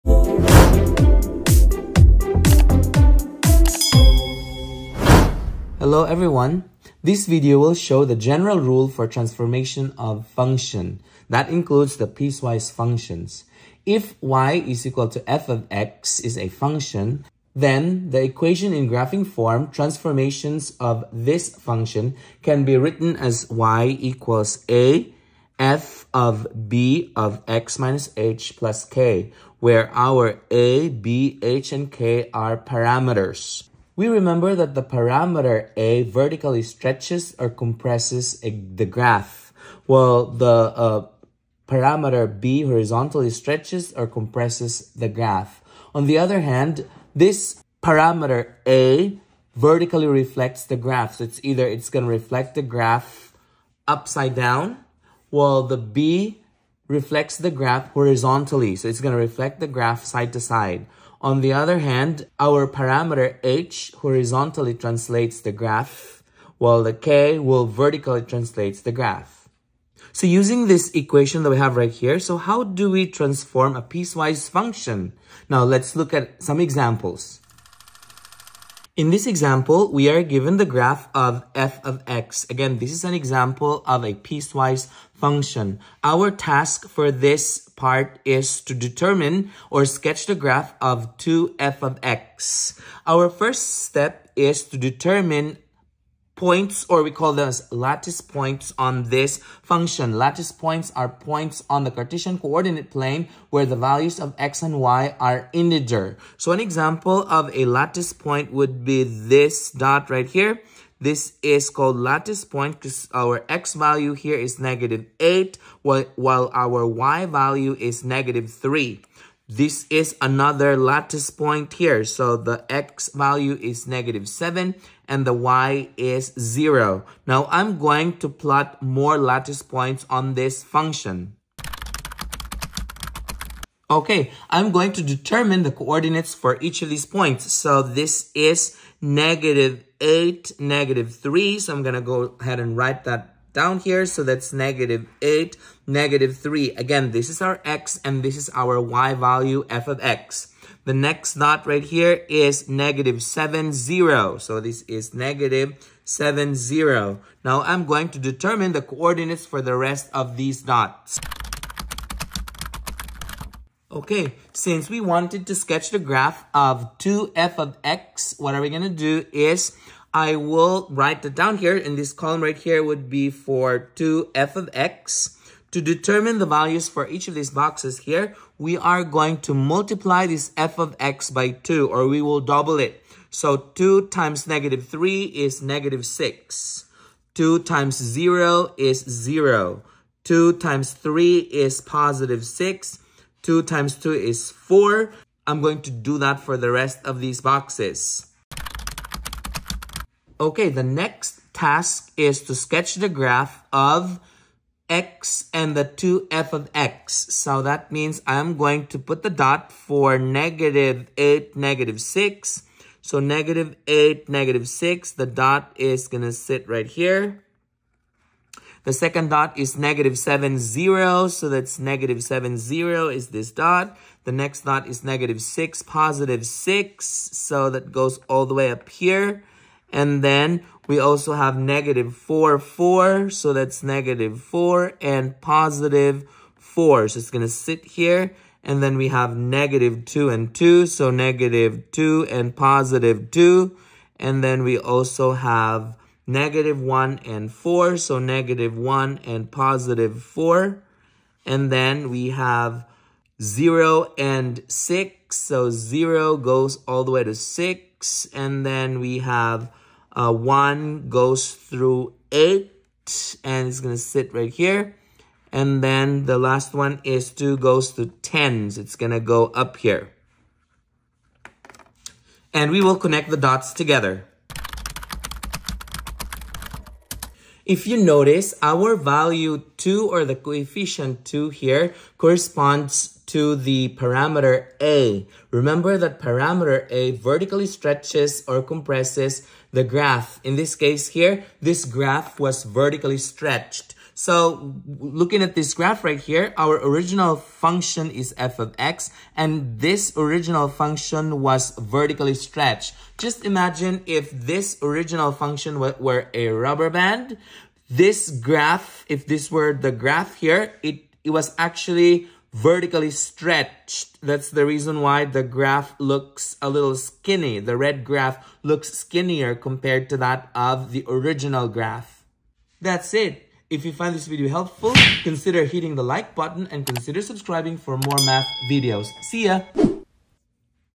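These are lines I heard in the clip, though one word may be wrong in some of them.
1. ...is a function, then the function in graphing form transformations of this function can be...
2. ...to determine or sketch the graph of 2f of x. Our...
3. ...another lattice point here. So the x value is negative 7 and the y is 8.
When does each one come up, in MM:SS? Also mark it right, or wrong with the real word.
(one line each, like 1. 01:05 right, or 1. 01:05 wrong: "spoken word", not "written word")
1. 00:16 wrong: "equation", not "function"
2. 01:28 right
3. 02:00 wrong: "0", not "8".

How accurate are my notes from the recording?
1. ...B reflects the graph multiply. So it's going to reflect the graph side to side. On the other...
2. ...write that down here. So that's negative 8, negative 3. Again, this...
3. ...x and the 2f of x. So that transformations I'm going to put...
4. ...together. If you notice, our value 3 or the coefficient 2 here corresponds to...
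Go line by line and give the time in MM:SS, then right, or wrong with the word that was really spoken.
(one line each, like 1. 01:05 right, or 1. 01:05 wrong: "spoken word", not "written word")
1. 00:55 wrong: "horizontally", not "multiply"
2. 02:22 right
3. 03:24 wrong: "means", not "transformations"
4. 04:33 wrong: "2", not "3".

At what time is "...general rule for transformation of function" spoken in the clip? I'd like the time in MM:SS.
00:08.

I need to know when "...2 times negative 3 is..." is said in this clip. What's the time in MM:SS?
03:03.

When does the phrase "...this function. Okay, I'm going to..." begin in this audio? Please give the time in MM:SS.
02:10.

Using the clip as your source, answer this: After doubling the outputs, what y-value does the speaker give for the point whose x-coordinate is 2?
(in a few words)
10.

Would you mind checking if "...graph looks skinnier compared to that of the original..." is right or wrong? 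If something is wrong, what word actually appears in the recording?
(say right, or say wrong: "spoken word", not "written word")
right.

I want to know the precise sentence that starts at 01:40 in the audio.
Lattice points are points on the Cartesian coordinate plane where the values of x and y are integer.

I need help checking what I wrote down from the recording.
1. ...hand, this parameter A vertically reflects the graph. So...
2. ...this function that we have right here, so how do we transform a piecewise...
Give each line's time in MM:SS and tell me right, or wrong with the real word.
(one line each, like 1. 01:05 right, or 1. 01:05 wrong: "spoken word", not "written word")
1. 00:46 right
2. 01:10 wrong: "equation", not "function".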